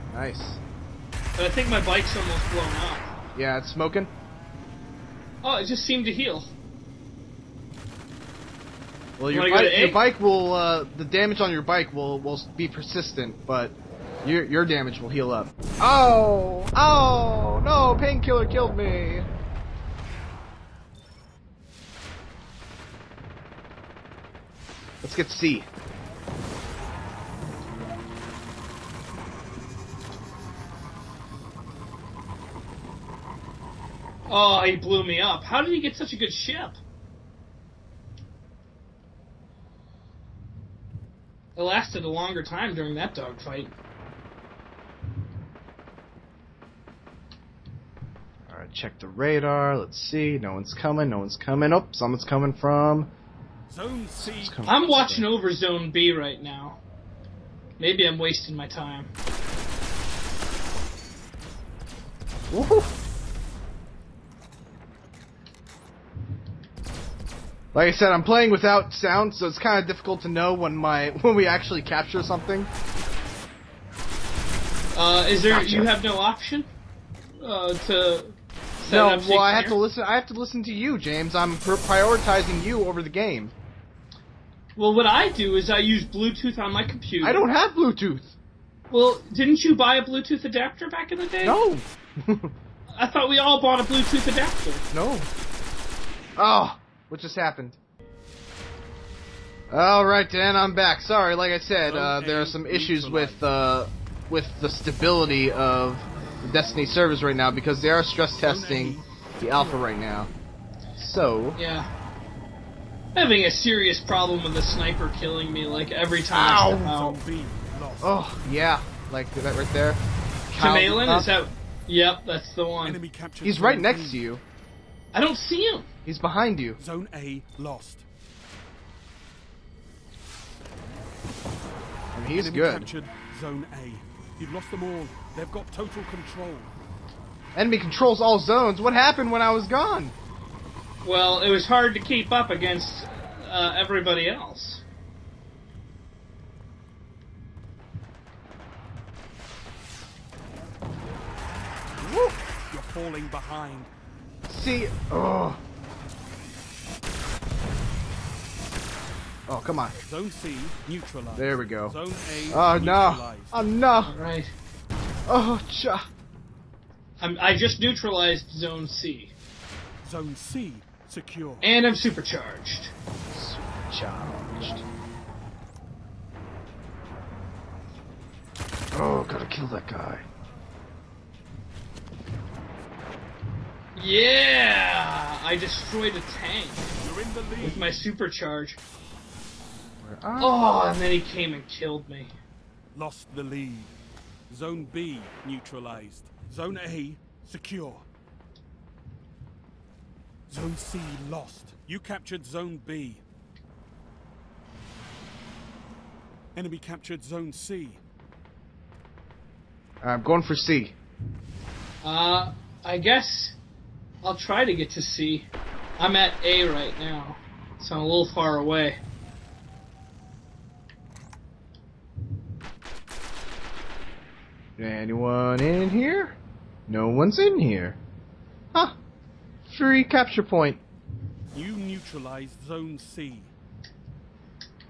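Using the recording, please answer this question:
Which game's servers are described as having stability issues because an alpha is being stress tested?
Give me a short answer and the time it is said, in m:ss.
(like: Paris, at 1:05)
Destiny, at 1:46.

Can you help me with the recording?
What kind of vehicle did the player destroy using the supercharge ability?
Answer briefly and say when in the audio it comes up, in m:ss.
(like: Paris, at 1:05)
A tank, at 3:06.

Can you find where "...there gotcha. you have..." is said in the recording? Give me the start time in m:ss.
1:15.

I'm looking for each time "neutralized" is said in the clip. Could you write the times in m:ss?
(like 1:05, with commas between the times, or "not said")
2:40, 2:47, 3:15, 3:51.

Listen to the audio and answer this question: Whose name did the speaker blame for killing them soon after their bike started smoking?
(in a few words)
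Painkiller.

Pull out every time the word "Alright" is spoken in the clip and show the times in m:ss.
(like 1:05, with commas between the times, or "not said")
0:48, 1:39.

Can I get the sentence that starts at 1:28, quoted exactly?
Well, didn't you buy a Bluetooth adapter back in the day?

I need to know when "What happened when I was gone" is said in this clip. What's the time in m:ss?
2:18.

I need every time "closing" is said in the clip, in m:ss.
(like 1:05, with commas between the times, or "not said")
not said.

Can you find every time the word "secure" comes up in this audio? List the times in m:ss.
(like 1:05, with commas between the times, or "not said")
2:51, 3:17.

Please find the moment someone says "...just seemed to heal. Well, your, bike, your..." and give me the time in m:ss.
0:05.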